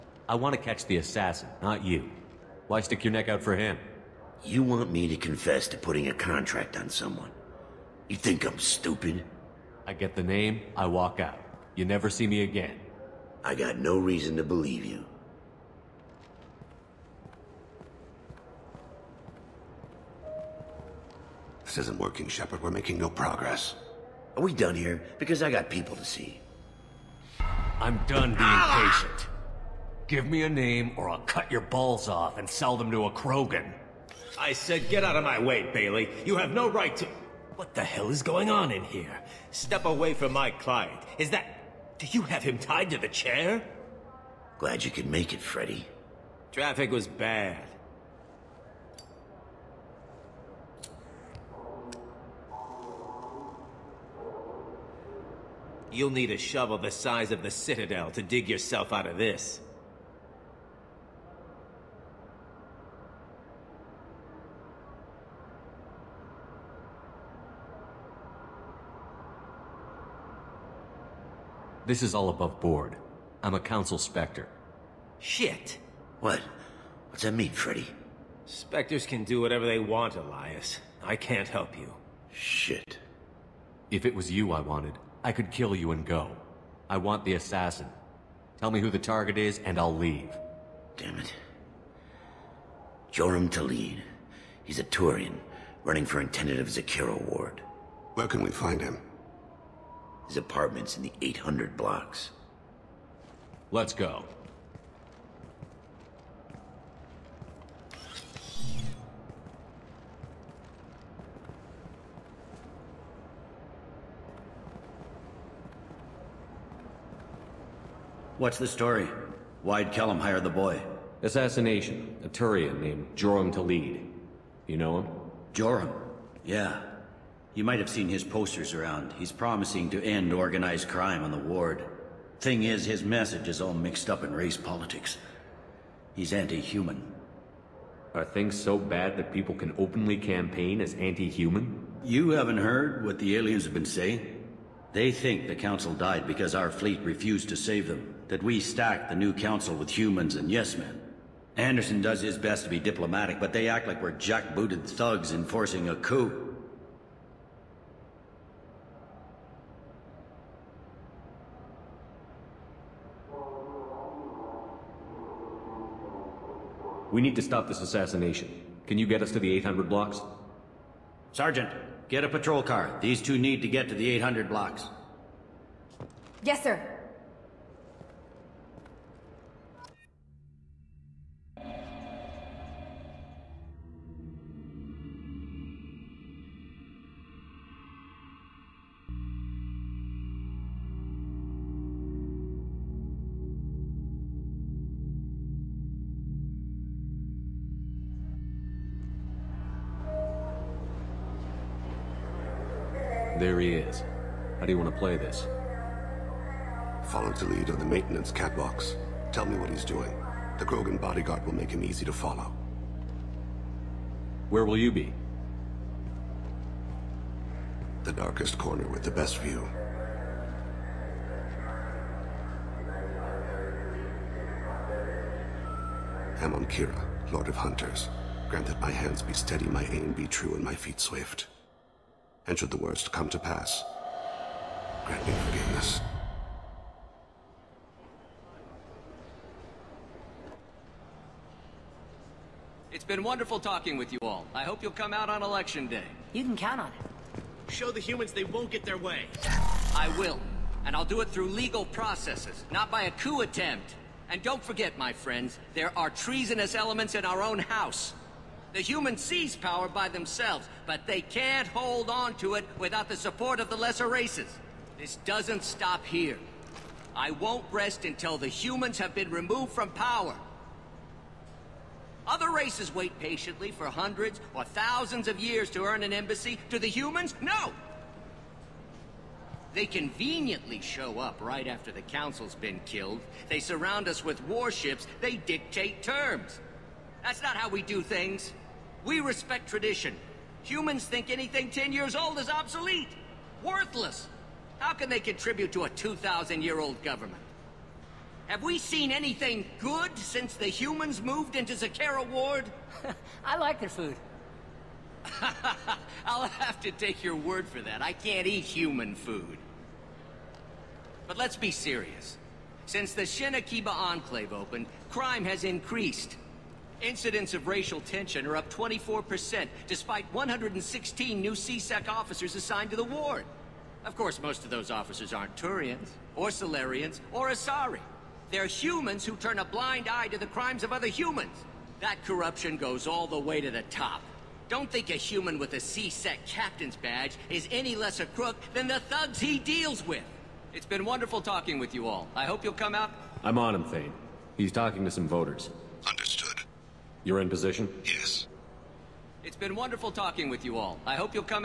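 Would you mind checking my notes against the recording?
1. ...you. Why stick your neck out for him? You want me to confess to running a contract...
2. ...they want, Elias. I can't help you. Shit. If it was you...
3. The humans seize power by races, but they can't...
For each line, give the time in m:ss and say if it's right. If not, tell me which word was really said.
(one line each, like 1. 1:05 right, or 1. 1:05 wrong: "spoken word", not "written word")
1. 0:01 wrong: "putting", not "running"
2. 1:19 right
3. 4:18 wrong: "themselves", not "races".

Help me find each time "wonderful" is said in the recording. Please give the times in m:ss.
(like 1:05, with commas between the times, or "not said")
4:03, 5:41, 5:49.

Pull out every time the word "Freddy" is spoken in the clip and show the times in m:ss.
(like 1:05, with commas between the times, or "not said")
0:45, 1:17.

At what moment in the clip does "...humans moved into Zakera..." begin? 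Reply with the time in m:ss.
5:00.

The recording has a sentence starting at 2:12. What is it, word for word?
Thing is, his message is all mixed up in race politics.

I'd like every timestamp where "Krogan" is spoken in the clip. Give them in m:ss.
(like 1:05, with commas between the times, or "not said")
0:33, 3:30.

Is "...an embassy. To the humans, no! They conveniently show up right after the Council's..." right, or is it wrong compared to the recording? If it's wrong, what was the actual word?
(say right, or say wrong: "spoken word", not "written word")
right.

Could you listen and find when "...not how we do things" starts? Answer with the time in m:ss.
4:47.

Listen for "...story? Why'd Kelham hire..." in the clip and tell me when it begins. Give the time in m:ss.
1:58.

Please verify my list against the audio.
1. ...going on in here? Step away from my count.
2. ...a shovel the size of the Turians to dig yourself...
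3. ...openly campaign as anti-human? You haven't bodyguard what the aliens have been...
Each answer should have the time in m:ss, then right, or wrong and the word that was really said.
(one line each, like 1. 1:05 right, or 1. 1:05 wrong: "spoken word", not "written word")
1. 0:38 wrong: "client", not "count"
2. 0:56 wrong: "Citadel", not "Turians"
3. 2:19 wrong: "heard", not "bodyguard".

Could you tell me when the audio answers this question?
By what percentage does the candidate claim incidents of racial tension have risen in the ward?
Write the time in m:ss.
5:18.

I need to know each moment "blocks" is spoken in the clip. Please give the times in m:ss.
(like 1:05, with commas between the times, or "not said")
1:41, 2:49, 2:54.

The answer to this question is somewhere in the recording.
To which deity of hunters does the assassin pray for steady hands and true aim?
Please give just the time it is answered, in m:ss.
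3:46.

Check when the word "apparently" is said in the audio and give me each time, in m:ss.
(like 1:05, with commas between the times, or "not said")
not said.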